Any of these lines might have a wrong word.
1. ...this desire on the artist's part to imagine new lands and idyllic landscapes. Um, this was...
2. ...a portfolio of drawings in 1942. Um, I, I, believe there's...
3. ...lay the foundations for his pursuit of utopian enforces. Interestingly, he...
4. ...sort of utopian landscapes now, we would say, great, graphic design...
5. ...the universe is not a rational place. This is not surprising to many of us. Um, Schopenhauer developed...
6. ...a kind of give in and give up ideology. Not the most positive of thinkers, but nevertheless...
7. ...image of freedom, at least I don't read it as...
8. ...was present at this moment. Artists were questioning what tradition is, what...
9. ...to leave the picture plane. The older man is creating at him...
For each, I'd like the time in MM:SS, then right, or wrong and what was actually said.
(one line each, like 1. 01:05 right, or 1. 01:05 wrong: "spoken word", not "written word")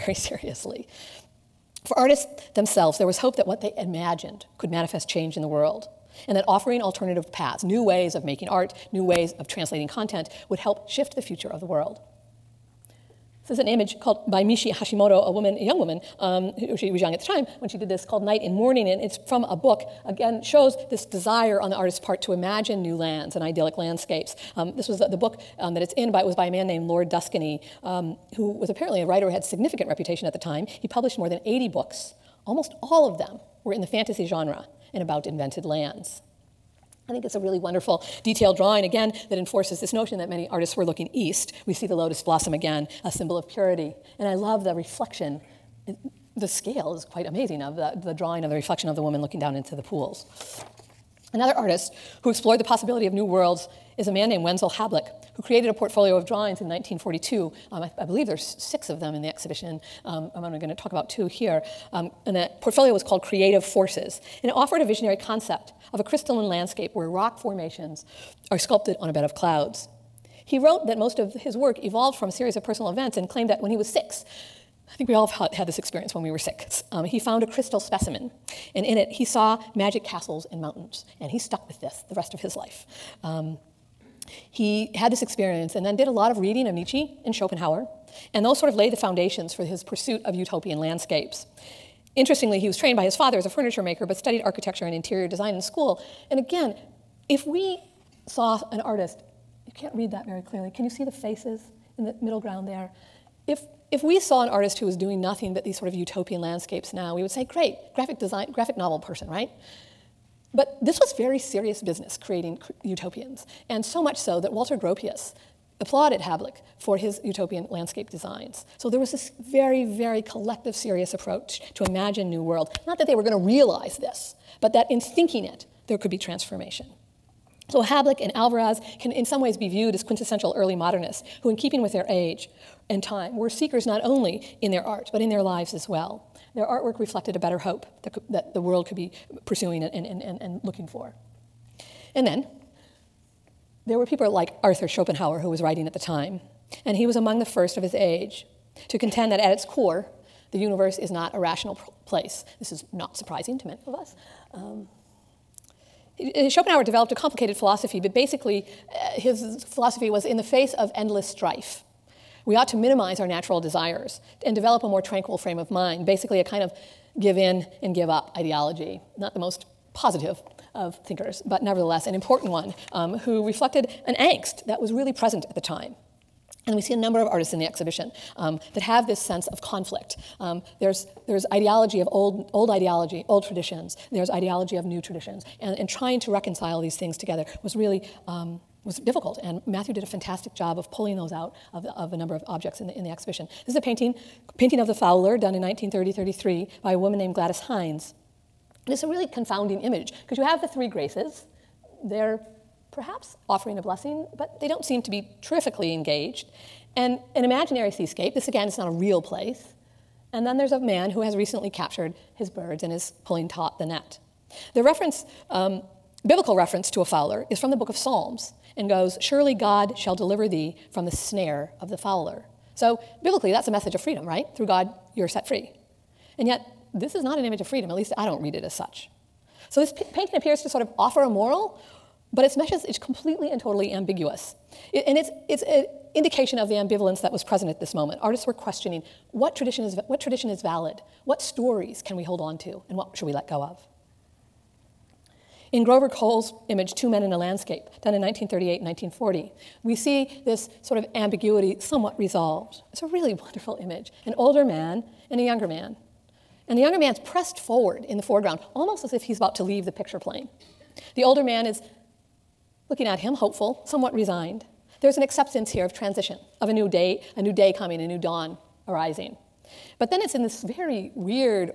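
1. 00:20 right
2. 00:55 right
3. 01:28 wrong: "landscapes", not "enforces"
4. 01:45 right
5. 02:30 right
6. 02:46 right
7. 03:47 right
8. 03:57 right
9. 04:19 wrong: "looking", not "creating".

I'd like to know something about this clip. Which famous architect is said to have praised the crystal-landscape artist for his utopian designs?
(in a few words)
Walter Gropius.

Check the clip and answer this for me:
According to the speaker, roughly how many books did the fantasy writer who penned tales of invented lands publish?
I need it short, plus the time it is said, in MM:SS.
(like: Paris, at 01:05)
more than 80, at 00:31.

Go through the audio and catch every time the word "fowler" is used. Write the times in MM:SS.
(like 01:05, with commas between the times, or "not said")
03:14, 03:37, 03:41.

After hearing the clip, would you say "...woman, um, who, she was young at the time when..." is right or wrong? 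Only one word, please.
right.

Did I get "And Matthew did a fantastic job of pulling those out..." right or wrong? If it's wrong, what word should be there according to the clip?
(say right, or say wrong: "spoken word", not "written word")
right.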